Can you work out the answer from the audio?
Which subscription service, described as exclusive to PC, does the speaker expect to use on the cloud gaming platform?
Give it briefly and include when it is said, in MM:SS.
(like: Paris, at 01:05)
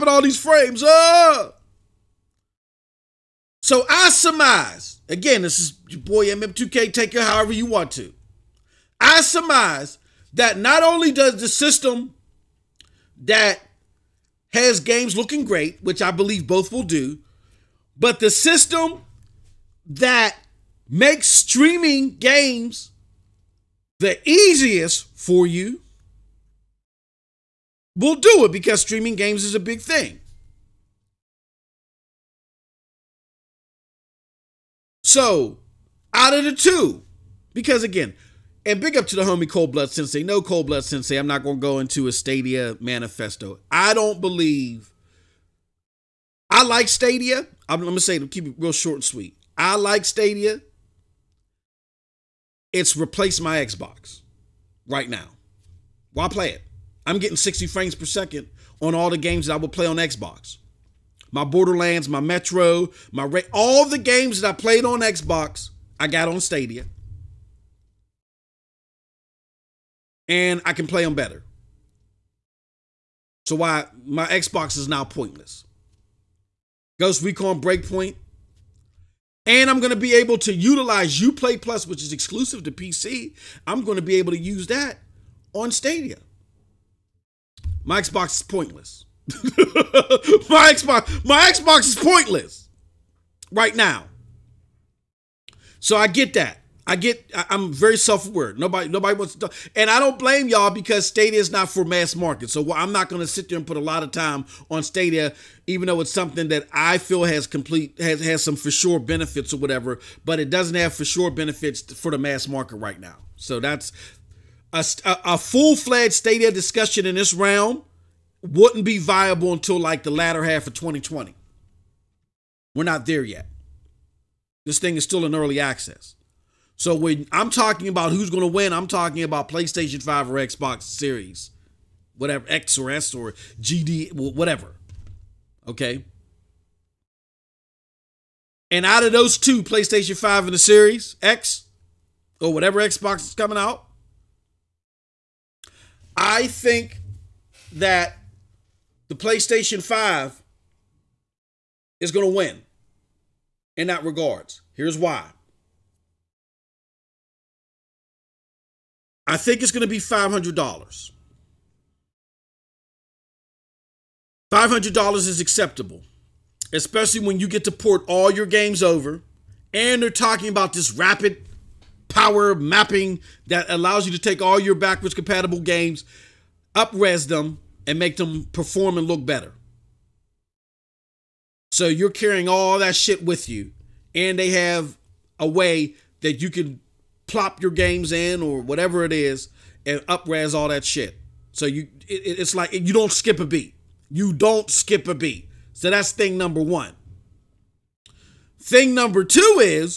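Uplay Plus, at 01:21.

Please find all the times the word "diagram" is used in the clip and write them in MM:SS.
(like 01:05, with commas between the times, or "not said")
not said.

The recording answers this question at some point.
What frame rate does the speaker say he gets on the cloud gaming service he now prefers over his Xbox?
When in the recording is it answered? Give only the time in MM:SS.
00:57.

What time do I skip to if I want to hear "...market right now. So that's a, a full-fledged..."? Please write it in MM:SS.
01:52.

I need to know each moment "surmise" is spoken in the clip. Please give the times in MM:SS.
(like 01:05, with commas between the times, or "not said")
00:04, 00:09.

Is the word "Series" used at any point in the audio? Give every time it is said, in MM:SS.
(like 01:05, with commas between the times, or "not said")
02:10, 02:20.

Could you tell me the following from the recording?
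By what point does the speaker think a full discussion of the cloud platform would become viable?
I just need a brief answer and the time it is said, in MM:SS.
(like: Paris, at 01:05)
latter half of 2020, at 02:00.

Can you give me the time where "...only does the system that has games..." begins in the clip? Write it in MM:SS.
00:10.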